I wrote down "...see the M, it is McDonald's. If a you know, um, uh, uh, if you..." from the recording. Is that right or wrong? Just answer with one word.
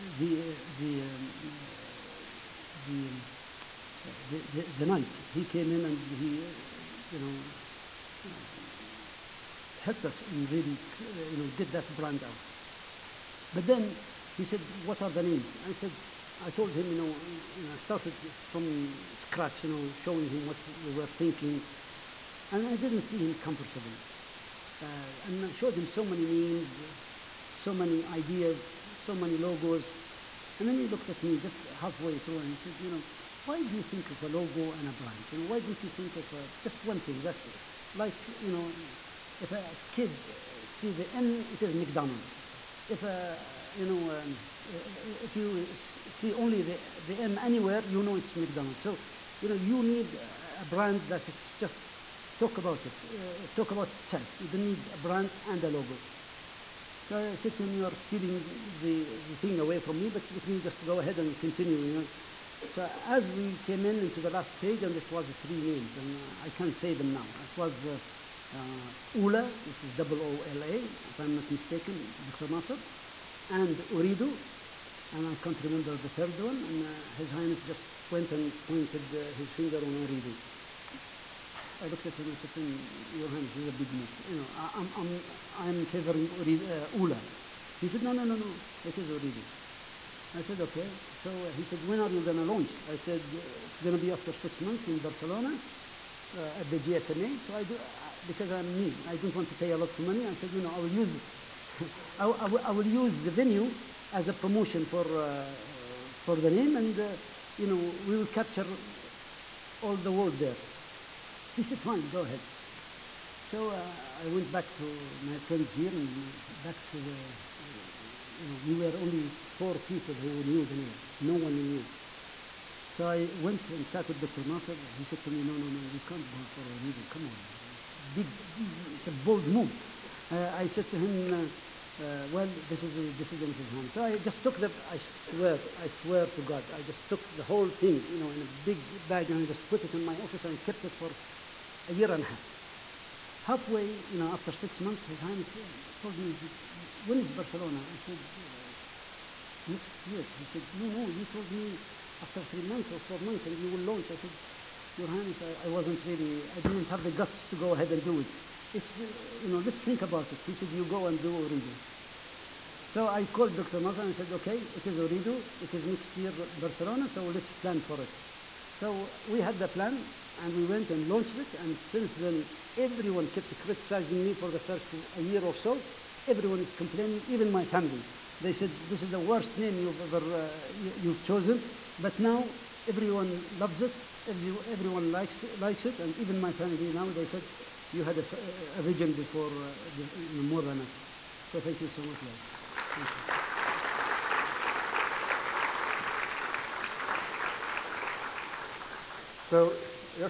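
right.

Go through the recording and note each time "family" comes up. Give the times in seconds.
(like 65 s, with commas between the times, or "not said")
177 s, 186 s.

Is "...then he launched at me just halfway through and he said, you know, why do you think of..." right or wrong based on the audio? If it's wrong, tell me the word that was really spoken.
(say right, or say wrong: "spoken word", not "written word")
wrong: "looked", not "launched".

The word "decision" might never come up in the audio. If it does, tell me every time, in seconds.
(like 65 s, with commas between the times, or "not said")
133 s.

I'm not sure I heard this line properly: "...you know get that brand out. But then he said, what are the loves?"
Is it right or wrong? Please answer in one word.
wrong.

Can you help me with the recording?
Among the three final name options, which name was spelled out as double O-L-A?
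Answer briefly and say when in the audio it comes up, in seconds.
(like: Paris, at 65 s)
Ula, at 69 s.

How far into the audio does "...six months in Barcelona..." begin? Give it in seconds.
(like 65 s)
94 s.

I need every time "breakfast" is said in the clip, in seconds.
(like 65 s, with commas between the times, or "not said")
not said.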